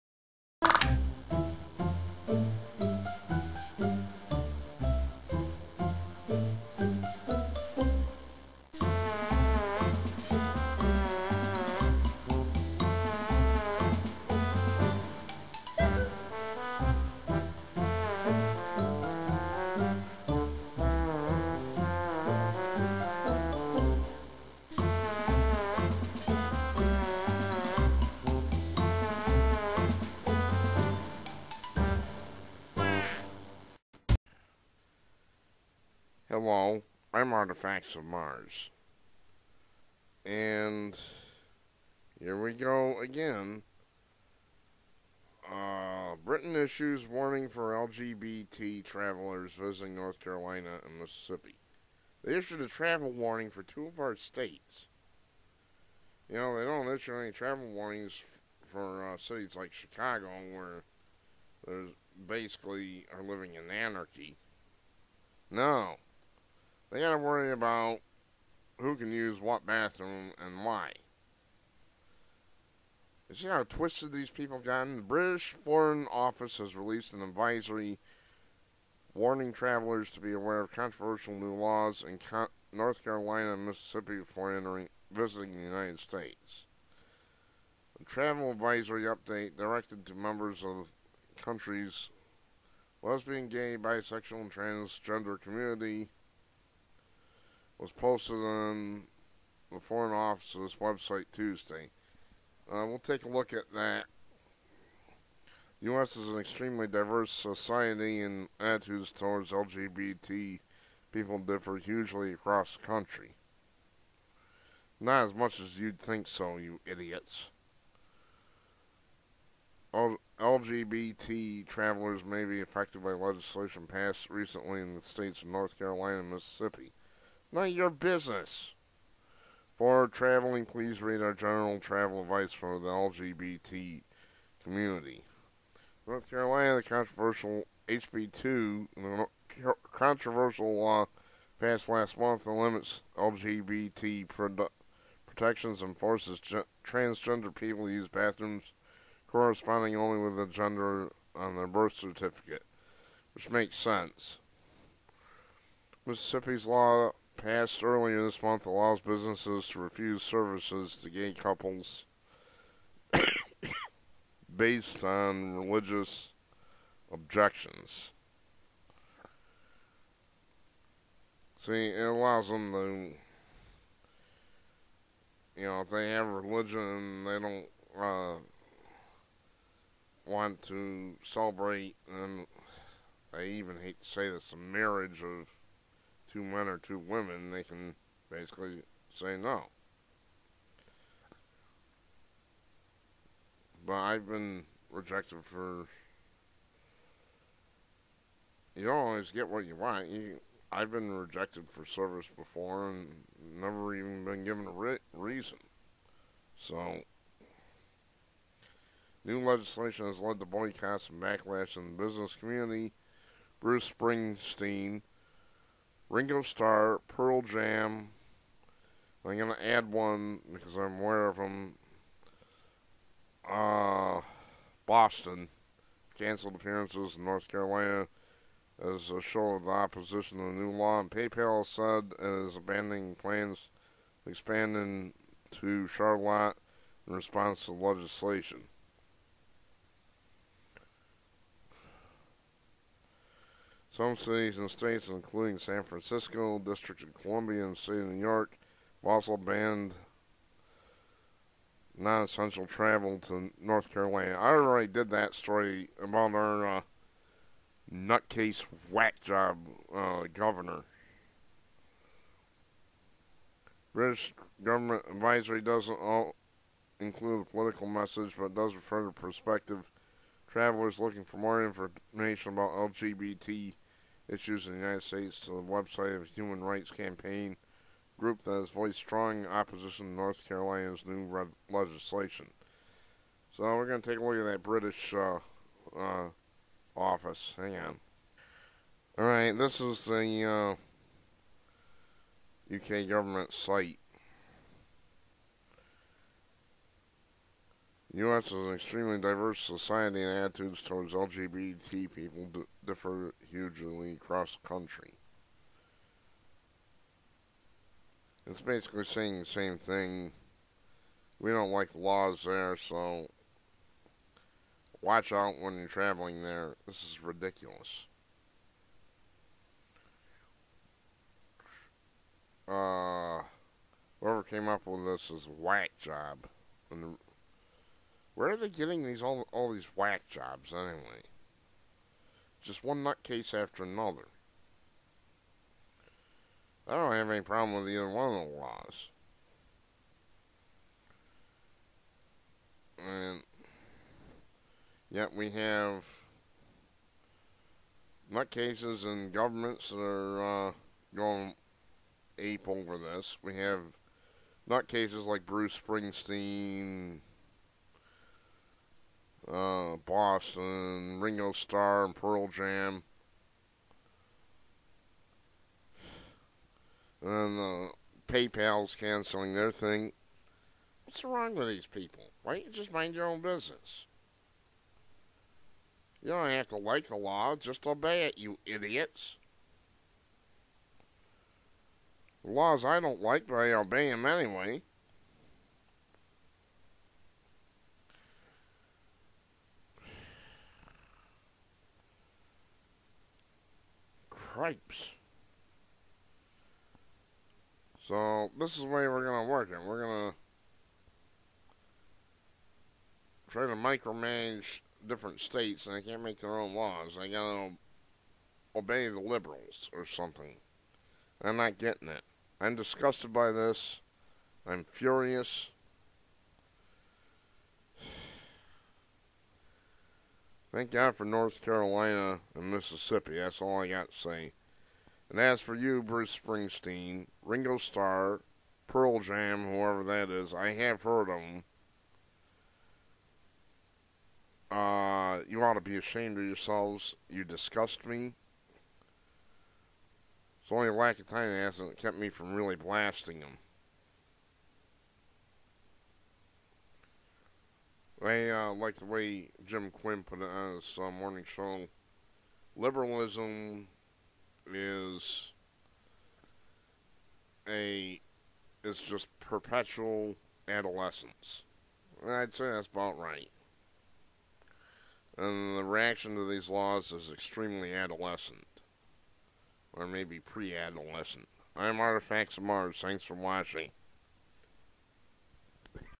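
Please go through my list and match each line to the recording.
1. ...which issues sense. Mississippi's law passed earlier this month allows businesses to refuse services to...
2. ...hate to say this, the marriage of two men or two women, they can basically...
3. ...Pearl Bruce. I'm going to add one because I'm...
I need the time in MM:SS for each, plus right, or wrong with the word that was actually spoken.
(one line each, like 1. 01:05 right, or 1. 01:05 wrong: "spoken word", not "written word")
1. 02:33 wrong: "makes", not "issues"
2. 03:03 right
3. 03:37 wrong: "Jam", not "Bruce".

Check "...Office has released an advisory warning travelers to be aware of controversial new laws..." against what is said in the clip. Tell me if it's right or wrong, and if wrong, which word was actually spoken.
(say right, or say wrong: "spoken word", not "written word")
right.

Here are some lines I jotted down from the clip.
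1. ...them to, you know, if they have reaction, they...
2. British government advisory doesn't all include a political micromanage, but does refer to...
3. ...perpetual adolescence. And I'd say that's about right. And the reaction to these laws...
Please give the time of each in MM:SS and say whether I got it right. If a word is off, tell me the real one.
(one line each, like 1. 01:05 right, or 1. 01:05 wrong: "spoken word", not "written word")
1. 02:52 wrong: "religion", not "reaction"
2. 04:23 wrong: "message", not "micromanage"
3. 07:39 right.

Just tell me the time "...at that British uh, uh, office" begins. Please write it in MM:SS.
04:44.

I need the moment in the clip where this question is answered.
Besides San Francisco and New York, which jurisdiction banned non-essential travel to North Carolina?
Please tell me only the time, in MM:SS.
04:06.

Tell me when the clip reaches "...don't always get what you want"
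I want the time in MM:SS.
03:18.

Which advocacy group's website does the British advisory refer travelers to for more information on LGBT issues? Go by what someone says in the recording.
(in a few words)
Human Rights Campaign.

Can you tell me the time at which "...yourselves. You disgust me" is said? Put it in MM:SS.
07:16.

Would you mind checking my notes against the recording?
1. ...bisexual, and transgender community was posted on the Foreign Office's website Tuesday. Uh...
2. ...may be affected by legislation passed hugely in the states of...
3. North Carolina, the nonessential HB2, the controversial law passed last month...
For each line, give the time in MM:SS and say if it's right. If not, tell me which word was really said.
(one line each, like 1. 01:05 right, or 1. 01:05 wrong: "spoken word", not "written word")
1. 01:33 right
2. 02:02 wrong: "recently", not "hugely"
3. 02:16 wrong: "controversial", not "nonessential".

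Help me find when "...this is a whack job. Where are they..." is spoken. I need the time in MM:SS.
05:25.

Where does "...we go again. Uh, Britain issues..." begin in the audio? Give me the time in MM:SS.
00:42.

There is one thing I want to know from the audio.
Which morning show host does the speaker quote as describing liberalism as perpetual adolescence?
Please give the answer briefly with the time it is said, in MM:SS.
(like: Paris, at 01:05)
Jim Quinn, at 07:29.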